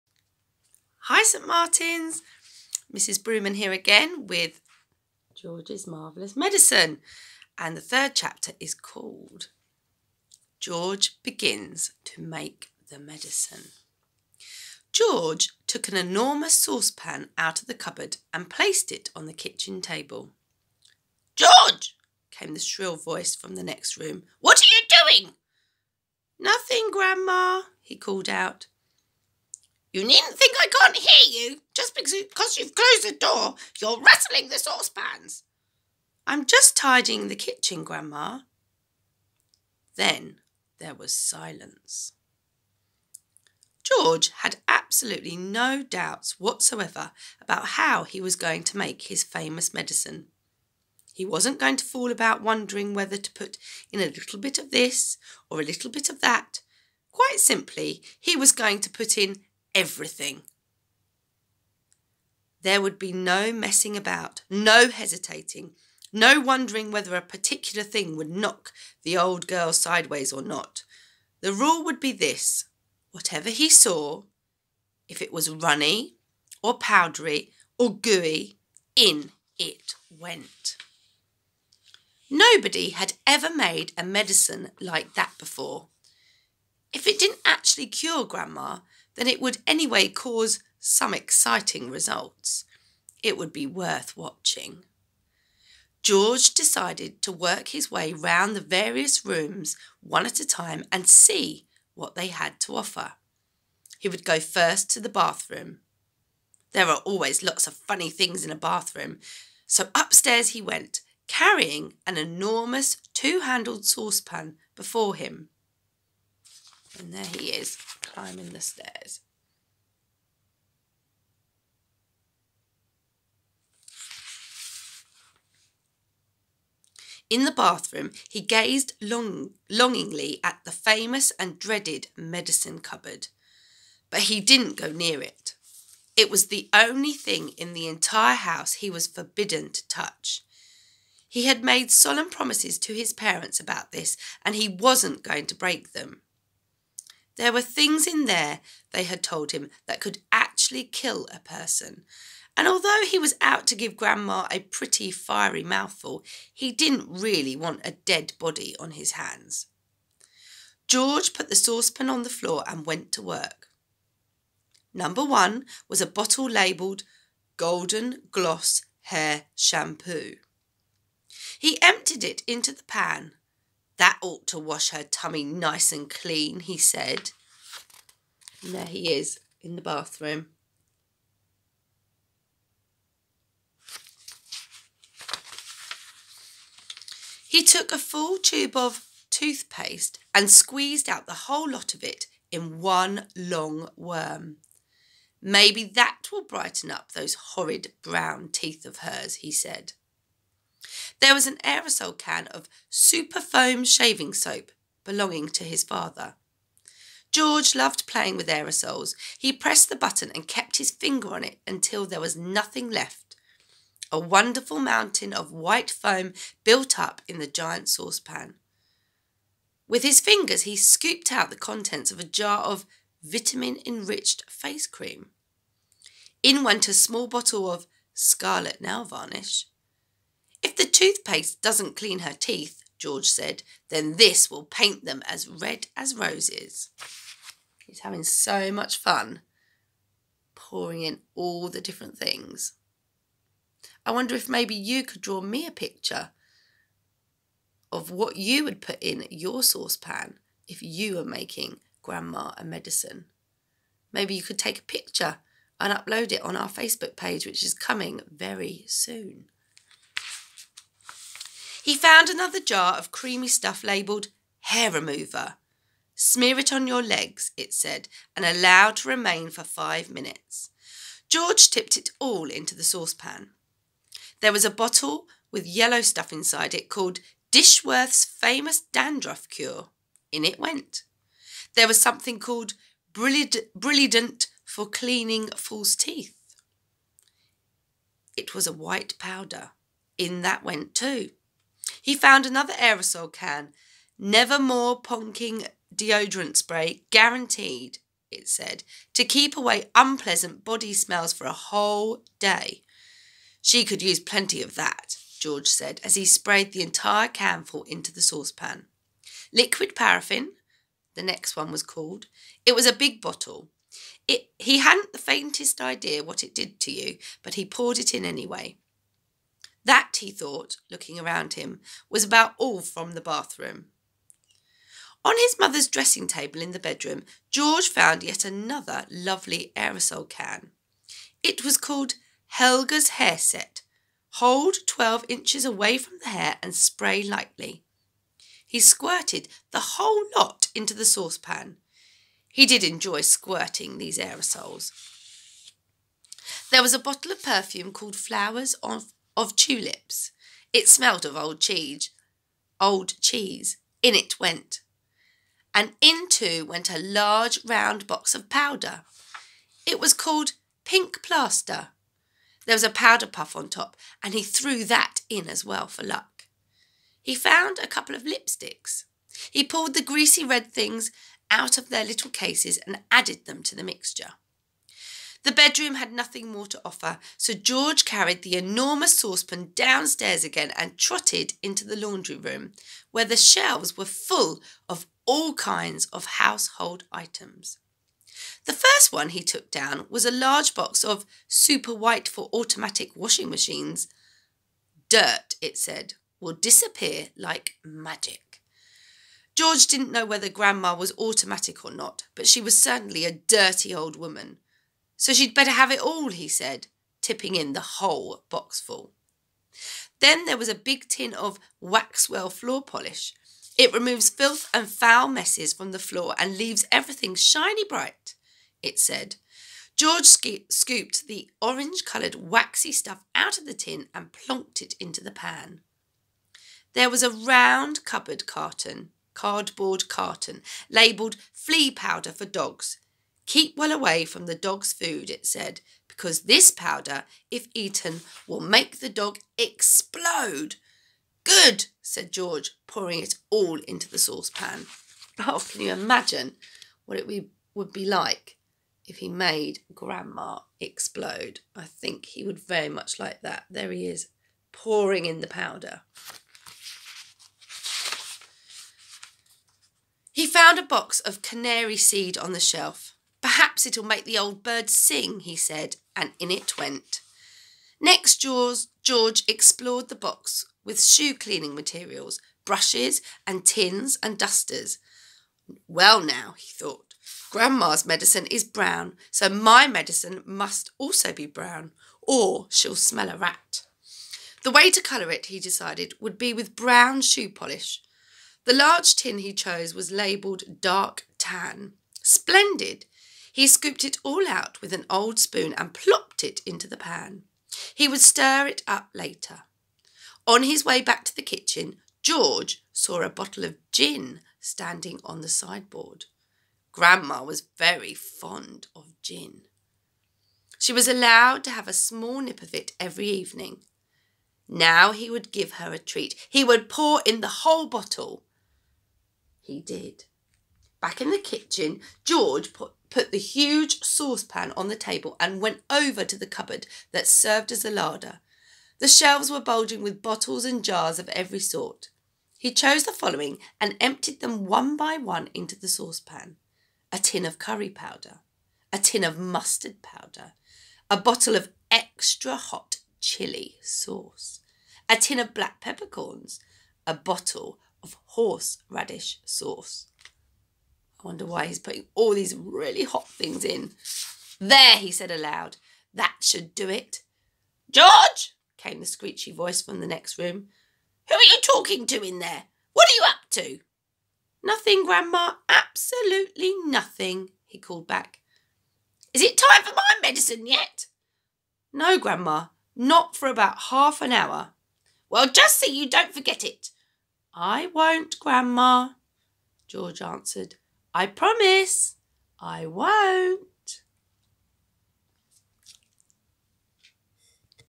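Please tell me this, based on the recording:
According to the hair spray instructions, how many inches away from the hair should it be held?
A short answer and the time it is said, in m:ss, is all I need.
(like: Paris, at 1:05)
12, at 5:34.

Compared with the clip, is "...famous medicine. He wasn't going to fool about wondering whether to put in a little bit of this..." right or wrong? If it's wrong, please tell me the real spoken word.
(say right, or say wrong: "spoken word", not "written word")
right.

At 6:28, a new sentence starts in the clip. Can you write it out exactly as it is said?
The first one he took down was a large box of super white for automatic washing machines.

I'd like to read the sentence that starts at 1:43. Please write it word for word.
He would go first to the bathroom.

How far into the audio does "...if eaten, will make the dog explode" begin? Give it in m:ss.
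7:17.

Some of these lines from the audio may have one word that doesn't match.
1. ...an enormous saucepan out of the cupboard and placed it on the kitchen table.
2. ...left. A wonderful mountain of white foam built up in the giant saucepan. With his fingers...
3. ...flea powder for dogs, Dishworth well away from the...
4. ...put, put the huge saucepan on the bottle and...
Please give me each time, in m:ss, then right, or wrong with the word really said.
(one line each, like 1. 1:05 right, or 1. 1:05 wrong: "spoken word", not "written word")
1. 0:15 right
2. 3:32 right
3. 7:11 wrong: "Keep", not "Dishworth"
4. 8:42 wrong: "table", not "bottle".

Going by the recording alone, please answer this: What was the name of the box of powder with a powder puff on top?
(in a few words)
Pink Plaster.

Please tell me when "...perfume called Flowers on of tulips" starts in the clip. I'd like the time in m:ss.
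5:47.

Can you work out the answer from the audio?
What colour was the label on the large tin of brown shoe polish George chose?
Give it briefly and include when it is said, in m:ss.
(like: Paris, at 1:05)
Dark tan, at 8:10.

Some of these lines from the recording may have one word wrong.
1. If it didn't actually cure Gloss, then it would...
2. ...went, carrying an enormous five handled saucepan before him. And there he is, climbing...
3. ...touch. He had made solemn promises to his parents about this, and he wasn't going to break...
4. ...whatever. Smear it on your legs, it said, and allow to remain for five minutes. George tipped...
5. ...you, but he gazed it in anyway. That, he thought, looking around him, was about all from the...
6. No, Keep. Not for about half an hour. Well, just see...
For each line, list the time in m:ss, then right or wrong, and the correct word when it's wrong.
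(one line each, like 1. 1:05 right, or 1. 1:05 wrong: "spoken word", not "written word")
1. 1:26 wrong: "Grandma", not "Gloss"
2. 1:50 wrong: "two", not "five"
3. 2:19 right
4. 4:24 wrong: "remover", not "whatever"
5. 5:16 wrong: "poured", not "gazed"
6. 9:31 wrong: "Grandma", not "Keep".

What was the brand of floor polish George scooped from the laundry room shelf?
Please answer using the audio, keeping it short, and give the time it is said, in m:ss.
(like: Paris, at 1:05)
Waxwell, at 6:51.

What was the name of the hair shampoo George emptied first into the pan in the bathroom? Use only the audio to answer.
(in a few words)
Golden Gloss.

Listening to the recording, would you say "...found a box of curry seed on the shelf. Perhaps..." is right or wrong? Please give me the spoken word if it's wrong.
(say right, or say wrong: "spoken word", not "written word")
wrong: "canary", not "curry".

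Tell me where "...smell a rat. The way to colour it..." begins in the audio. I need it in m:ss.
8:02.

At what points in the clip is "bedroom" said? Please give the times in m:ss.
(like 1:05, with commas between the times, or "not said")
5:26, 6:15.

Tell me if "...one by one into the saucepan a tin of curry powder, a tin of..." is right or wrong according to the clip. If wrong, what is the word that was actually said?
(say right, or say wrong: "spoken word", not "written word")
right.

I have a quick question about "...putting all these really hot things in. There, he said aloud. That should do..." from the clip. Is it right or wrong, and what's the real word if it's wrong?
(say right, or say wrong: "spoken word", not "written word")
right.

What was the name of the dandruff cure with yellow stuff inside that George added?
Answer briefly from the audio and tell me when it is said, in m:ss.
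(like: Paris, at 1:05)
Dishworth's famous dandruff cure, at 4:37.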